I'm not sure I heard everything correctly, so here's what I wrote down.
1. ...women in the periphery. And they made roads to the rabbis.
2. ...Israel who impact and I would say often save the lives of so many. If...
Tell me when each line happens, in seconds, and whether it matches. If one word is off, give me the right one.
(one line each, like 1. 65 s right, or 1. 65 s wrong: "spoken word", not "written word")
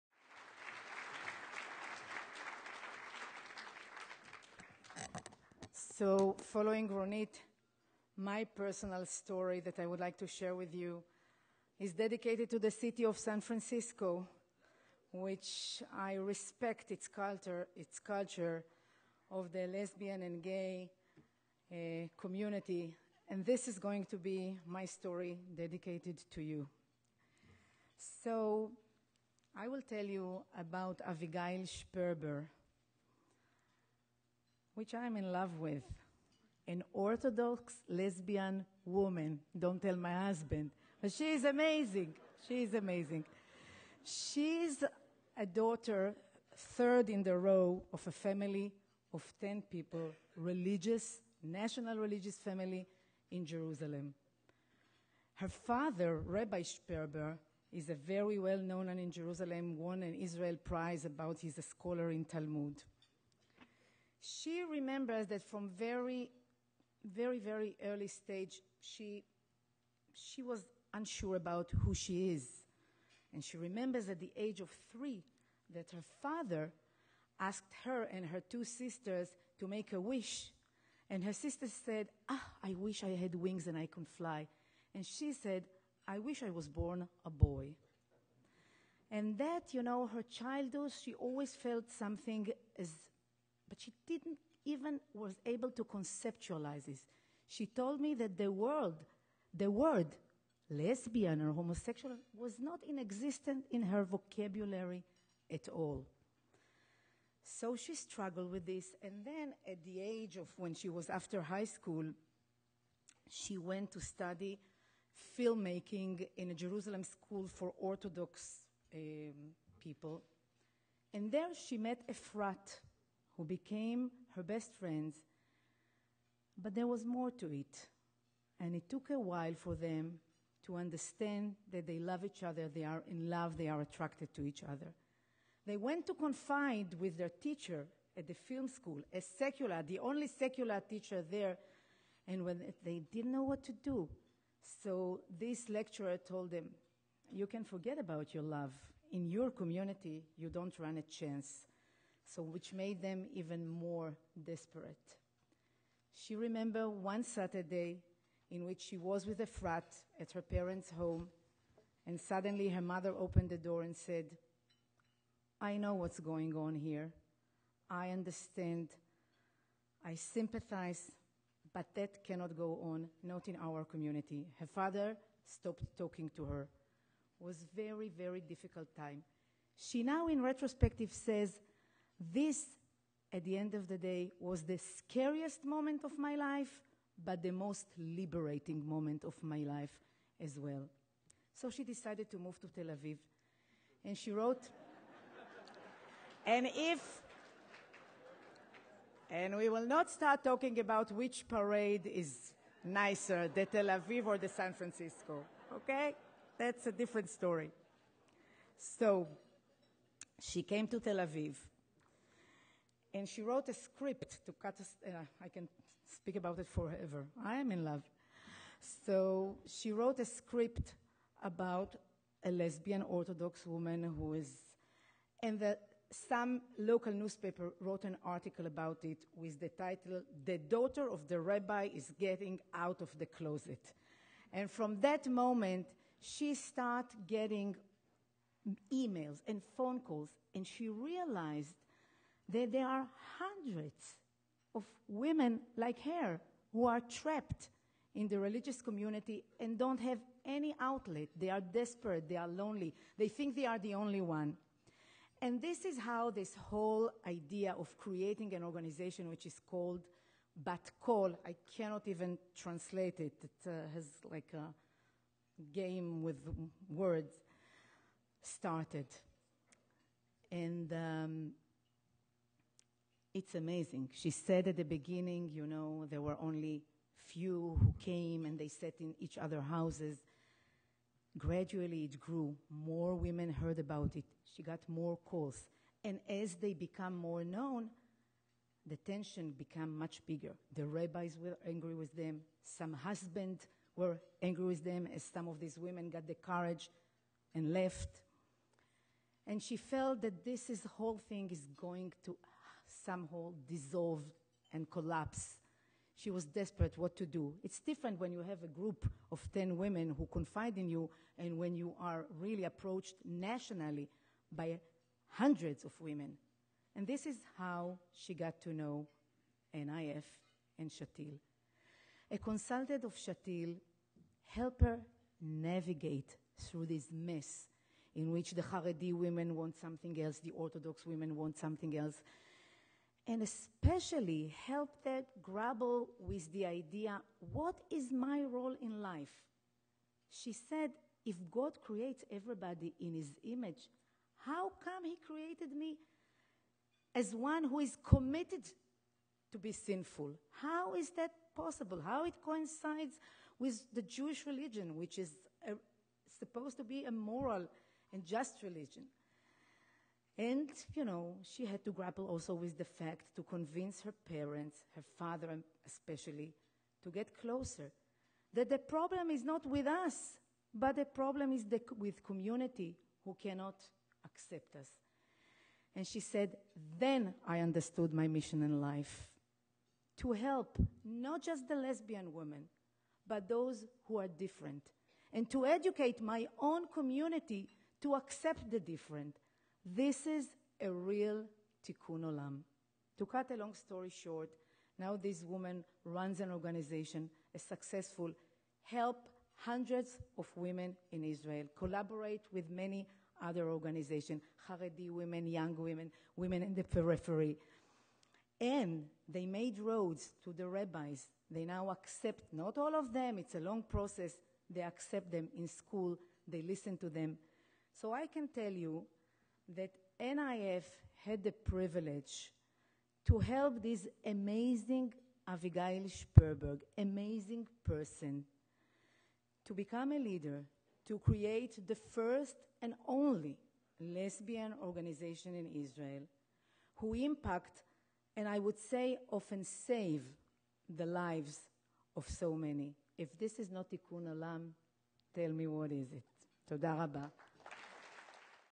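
1. 406 s right
2. 435 s right.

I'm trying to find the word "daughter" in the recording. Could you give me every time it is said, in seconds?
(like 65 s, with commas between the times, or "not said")
45 s, 230 s.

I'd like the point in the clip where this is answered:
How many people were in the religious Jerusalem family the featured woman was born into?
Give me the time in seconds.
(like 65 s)
49 s.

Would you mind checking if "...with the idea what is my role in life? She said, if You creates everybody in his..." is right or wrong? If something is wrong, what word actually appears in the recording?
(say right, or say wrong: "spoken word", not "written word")
wrong: "God", not "You".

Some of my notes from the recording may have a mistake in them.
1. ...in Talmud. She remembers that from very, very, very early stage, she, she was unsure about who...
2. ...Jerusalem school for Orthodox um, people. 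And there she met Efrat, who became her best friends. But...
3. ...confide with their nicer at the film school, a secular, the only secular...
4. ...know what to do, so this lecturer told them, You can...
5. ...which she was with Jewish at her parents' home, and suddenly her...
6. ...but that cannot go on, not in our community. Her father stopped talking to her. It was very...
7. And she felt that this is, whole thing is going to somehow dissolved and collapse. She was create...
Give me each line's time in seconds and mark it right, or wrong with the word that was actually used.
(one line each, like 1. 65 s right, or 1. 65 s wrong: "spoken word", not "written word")
1. 62 s right
2. 116 s right
3. 136 s wrong: "teacher", not "nicer"
4. 143 s right
5. 158 s wrong: "Efrat", not "Jewish"
6. 171 s right
7. 299 s wrong: "desperate", not "create".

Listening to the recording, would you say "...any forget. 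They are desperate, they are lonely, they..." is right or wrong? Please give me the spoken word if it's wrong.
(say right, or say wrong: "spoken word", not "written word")
wrong: "outlet", not "forget".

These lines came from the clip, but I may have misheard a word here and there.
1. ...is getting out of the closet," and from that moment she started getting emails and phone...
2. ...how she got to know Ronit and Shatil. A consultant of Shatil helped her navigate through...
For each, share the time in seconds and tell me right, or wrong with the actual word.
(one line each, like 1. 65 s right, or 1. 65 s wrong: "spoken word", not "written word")
1. 231 s right
2. 317 s wrong: "NIF", not "Ronit".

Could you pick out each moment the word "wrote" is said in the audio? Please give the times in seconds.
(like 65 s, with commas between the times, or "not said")
194 s, 213 s, 219 s, 227 s.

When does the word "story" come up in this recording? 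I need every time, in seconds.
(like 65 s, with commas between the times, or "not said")
9 s, 24 s, 207 s, 393 s.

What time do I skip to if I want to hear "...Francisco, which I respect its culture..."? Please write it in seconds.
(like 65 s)
13 s.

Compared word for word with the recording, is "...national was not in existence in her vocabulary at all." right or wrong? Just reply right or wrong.
wrong.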